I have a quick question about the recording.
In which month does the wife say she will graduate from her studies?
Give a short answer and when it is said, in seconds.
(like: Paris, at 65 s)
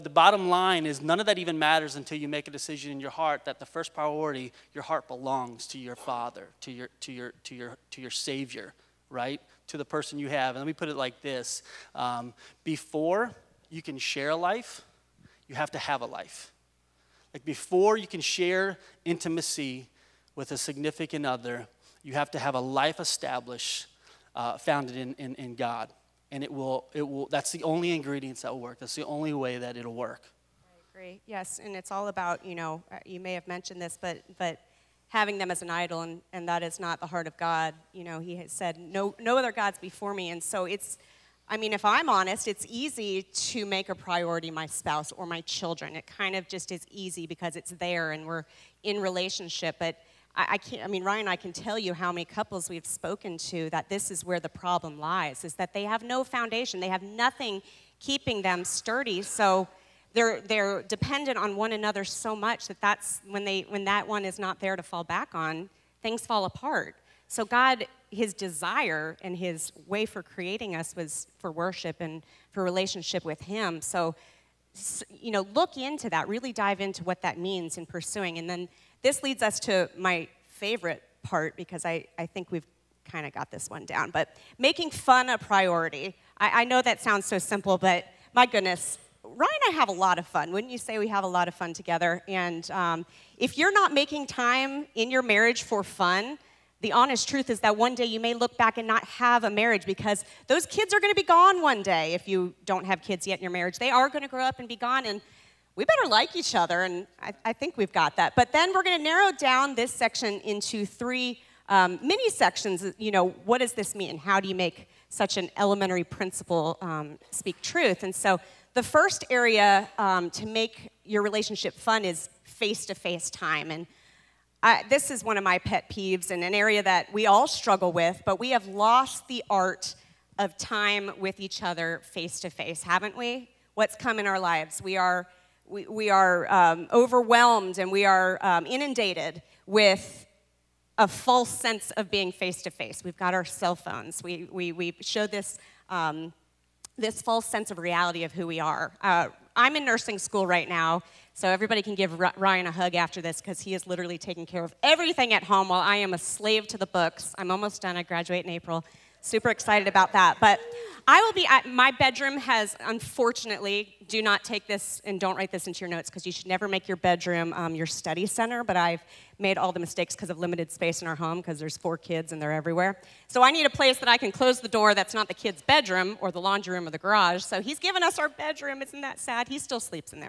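April, at 158 s.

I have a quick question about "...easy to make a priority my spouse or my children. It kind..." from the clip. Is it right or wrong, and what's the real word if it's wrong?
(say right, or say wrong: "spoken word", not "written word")
right.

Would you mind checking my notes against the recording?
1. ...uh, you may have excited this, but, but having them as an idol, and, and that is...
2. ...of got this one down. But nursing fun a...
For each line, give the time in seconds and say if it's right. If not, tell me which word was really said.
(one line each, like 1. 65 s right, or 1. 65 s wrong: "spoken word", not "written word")
1. 32 s wrong: "mentioned", not "excited"
2. 83 s wrong: "making", not "nursing".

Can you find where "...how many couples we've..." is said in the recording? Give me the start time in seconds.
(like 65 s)
51 s.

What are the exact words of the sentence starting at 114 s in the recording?
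How do you make such an elementary principle um, speak truth?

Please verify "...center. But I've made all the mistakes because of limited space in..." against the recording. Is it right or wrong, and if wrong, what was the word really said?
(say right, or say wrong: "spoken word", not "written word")
right.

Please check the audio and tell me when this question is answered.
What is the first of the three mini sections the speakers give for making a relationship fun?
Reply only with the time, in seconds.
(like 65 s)
122 s.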